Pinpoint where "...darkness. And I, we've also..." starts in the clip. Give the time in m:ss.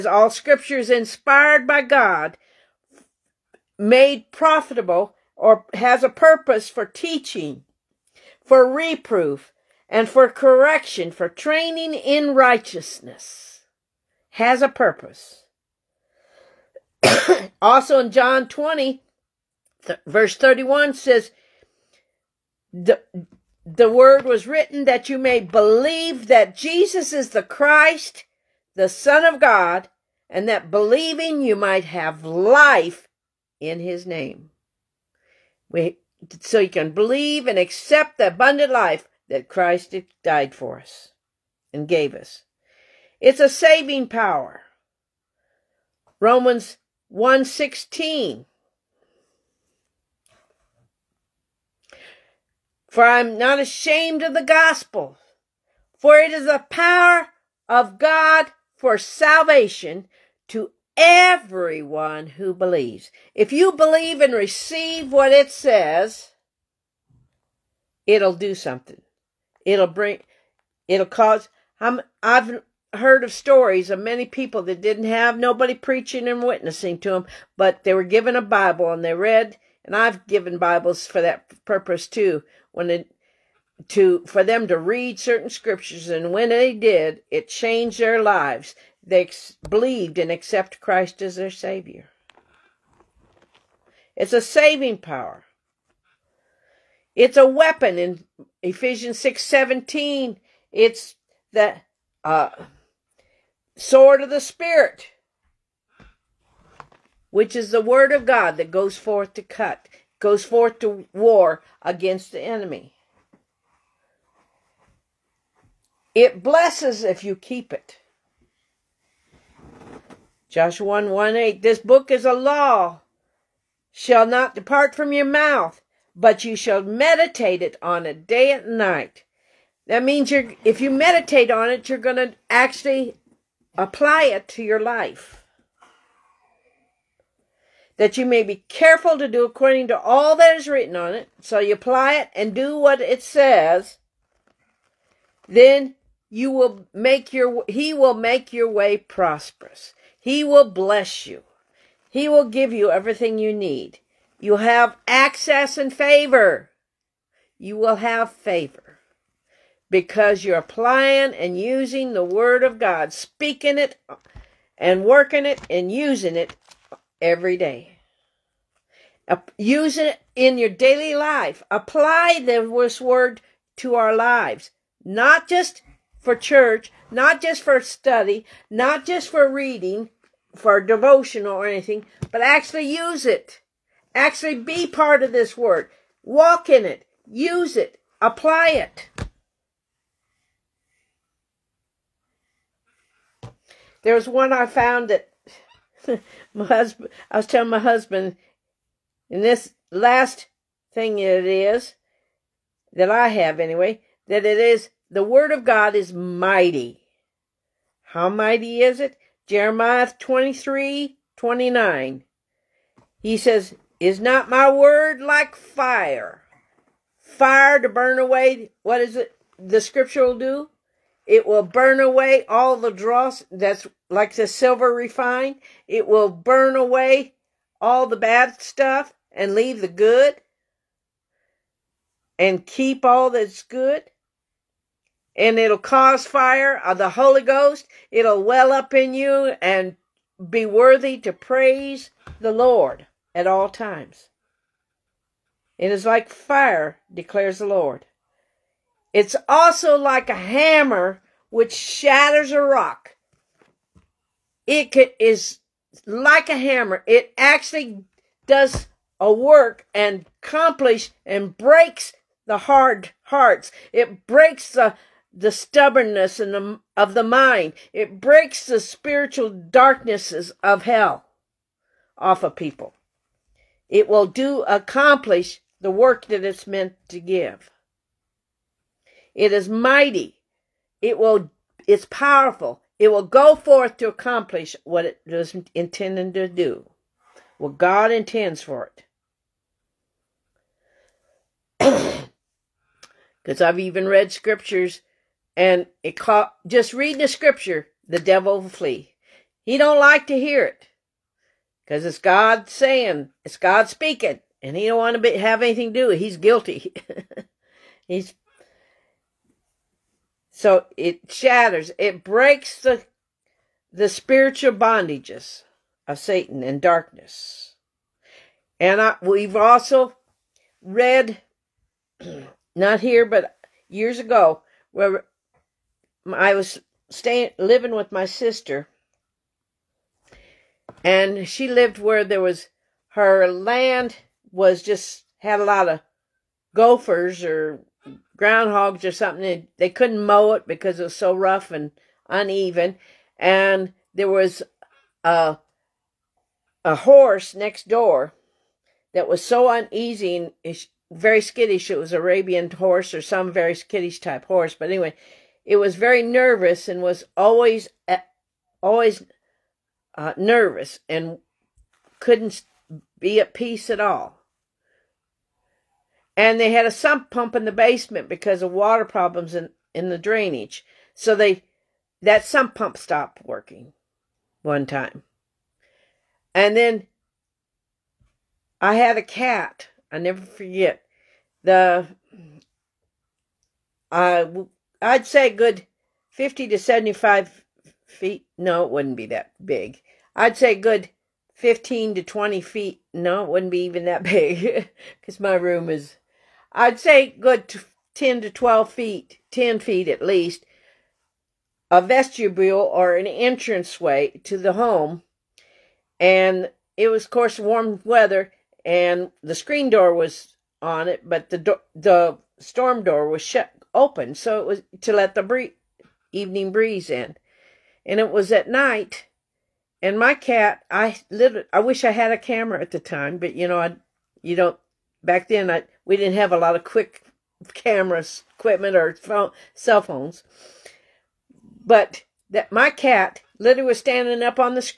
5:16.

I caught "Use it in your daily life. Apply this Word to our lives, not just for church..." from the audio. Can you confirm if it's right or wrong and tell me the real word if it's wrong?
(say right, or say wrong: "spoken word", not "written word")
right.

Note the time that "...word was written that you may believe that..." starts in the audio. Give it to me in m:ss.
0:23.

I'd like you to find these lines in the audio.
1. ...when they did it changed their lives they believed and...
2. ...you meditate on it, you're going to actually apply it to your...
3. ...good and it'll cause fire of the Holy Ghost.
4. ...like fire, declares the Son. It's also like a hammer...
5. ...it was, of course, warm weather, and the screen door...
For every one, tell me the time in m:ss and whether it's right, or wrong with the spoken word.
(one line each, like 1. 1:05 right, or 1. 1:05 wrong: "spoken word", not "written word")
1. 1:26 right
2. 2:10 right
3. 3:53 right
4. 4:06 wrong: "Lord", not "Son"
5. 6:46 right.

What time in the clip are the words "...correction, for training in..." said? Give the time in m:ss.
0:10.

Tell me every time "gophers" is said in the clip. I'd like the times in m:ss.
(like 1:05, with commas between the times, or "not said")
5:36.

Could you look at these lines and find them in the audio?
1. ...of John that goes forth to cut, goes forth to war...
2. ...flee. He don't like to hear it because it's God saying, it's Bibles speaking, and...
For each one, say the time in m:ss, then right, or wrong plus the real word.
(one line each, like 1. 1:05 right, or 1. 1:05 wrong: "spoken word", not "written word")
1. 1:48 wrong: "God", not "John"
2. 4:58 wrong: "God", not "Bibles".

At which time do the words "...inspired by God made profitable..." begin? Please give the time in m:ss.
0:00.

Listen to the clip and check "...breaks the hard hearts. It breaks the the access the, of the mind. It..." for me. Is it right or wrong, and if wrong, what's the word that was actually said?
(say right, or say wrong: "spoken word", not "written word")
wrong: "stubbornness", not "access".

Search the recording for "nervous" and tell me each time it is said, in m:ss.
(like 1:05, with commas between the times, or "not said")
5:56, 6:00.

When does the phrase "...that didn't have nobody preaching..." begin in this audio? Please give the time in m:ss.
1:14.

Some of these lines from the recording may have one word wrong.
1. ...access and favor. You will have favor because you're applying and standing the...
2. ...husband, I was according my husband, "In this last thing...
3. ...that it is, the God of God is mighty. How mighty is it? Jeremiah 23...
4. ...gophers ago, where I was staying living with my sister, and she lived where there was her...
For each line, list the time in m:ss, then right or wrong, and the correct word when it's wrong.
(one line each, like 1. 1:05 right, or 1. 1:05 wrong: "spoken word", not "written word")
1. 2:35 wrong: "using", not "standing"
2. 3:16 wrong: "telling", not "according"
3. 3:24 wrong: "Word", not "God"
4. 5:23 wrong: "years", not "gophers".